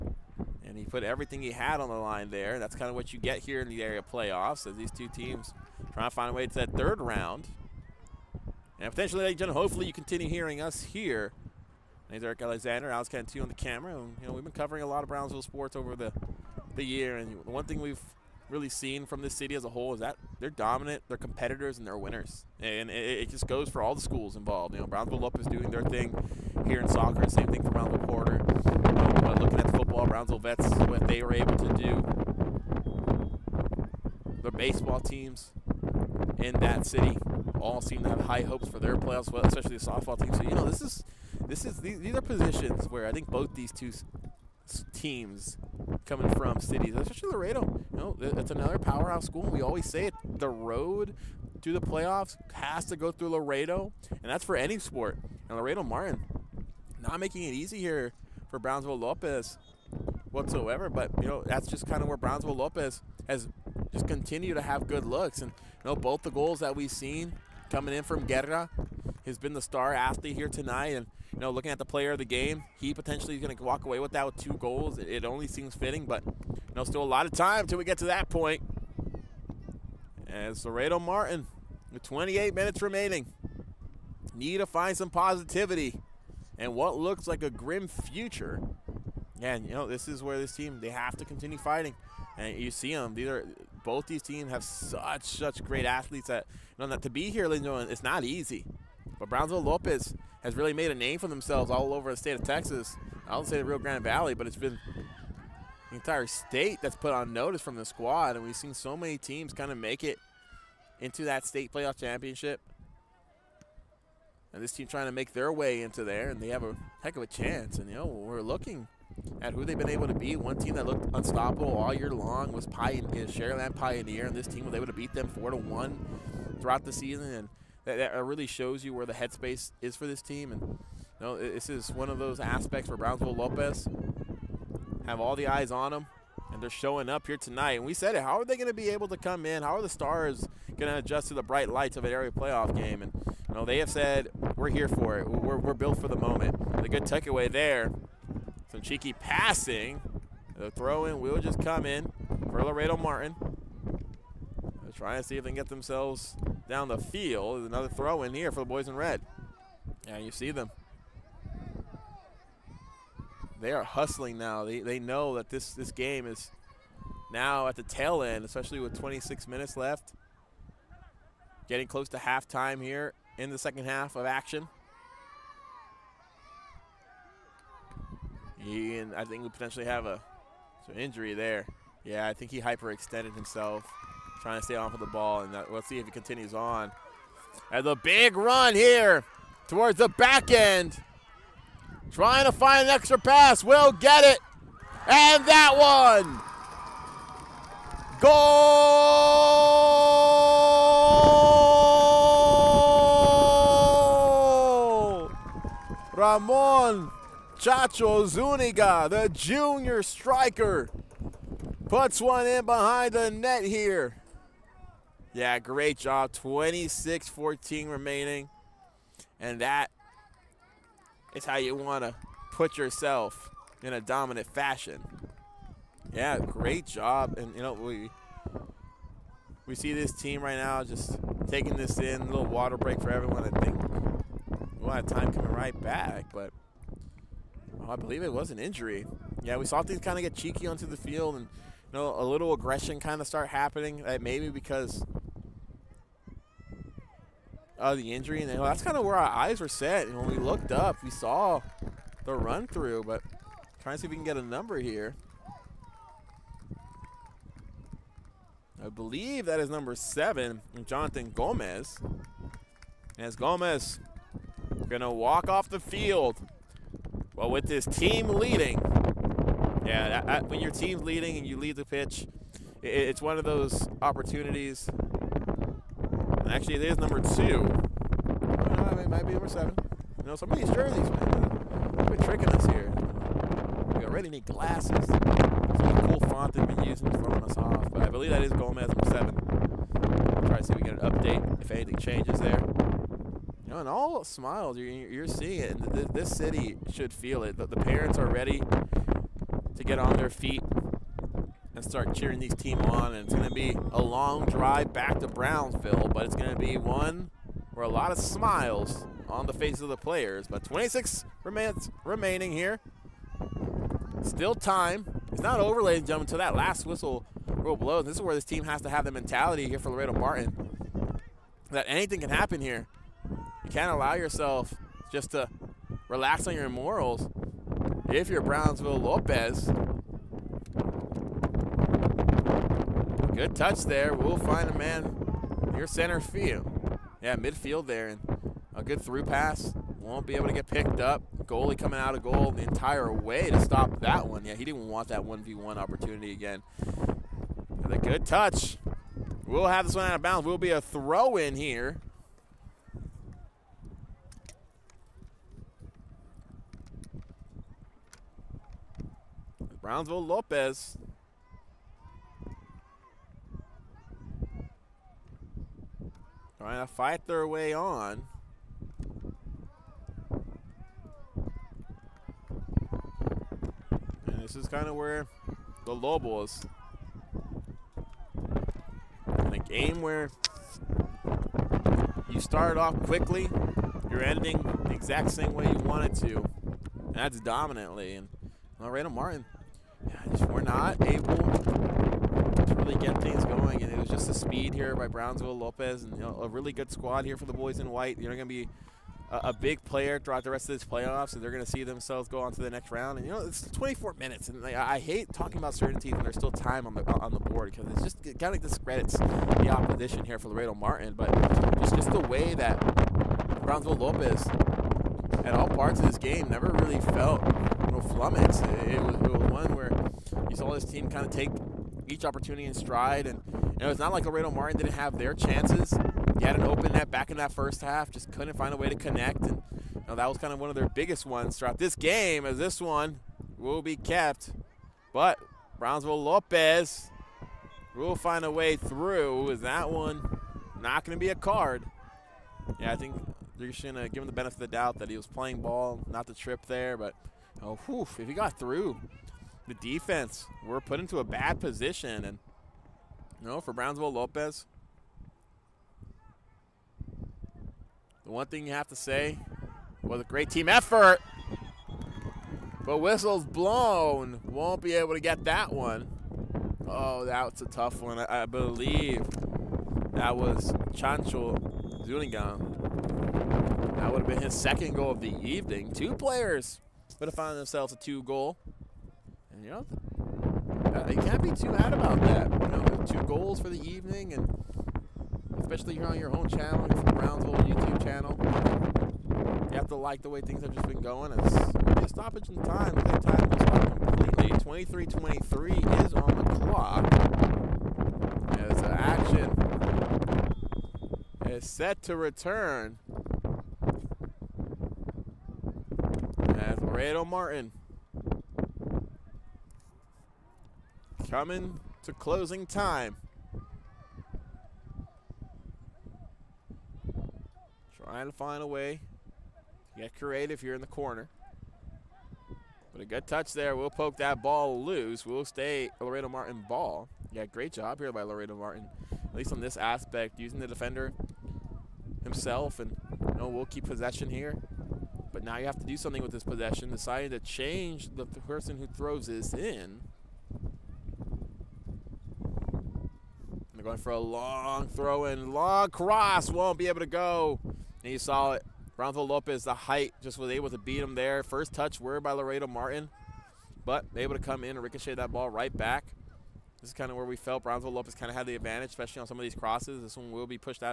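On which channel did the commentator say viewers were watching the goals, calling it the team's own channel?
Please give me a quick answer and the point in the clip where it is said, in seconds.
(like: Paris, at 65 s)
Brownsville YouTube channel, at 486 s.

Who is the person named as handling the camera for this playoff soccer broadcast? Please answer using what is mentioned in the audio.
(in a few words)
Alex Cantu.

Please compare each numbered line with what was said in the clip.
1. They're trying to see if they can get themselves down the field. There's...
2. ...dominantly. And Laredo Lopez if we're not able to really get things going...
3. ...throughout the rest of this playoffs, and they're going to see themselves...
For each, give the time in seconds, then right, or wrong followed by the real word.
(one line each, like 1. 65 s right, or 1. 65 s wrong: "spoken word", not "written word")
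1. 154 s right
2. 387 s wrong: "Martin", not "Lopez"
3. 400 s right.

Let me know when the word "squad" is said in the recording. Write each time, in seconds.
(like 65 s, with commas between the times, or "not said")
107 s, 396 s.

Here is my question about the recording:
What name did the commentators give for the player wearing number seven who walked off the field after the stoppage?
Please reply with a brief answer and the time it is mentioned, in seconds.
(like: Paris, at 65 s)
Jonathan Gomez, at 260 s.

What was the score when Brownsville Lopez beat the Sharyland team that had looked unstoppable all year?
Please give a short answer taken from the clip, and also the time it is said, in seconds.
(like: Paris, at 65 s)
4-1, at 125 s.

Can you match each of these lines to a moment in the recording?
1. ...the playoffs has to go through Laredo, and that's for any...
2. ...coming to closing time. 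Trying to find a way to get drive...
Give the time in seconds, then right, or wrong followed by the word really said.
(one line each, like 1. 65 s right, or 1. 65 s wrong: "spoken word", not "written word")
1. 51 s right
2. 511 s wrong: "creative", not "drive".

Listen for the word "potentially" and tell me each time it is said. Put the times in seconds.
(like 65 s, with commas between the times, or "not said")
8 s, 72 s, 179 s.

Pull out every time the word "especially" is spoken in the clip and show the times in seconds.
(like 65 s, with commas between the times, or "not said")
39 s, 46 s, 168 s, 485 s, 558 s.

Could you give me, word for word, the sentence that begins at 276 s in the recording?
And actually, it is number two.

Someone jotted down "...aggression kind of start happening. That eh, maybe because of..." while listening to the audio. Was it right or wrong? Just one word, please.
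right.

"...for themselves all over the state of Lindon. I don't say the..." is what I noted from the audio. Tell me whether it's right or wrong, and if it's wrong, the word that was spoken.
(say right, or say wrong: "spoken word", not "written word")
wrong: "Texas", not "Lindon".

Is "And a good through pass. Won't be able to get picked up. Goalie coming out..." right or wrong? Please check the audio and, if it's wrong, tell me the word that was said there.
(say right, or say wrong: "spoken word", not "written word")
right.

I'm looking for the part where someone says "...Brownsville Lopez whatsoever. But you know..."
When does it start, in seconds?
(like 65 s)
58 s.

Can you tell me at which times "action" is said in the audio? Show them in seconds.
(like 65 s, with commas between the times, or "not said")
174 s, 498 s.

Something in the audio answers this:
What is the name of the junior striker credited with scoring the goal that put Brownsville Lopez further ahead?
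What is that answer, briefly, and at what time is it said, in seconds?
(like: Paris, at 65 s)
Ramon Chacho Zuniga, at 206 s.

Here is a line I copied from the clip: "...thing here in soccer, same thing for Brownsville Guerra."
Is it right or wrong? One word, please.
wrong.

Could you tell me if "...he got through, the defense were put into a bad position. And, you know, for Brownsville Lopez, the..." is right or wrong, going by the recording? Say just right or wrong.
right.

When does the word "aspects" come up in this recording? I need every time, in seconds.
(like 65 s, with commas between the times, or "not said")
132 s, 529 s.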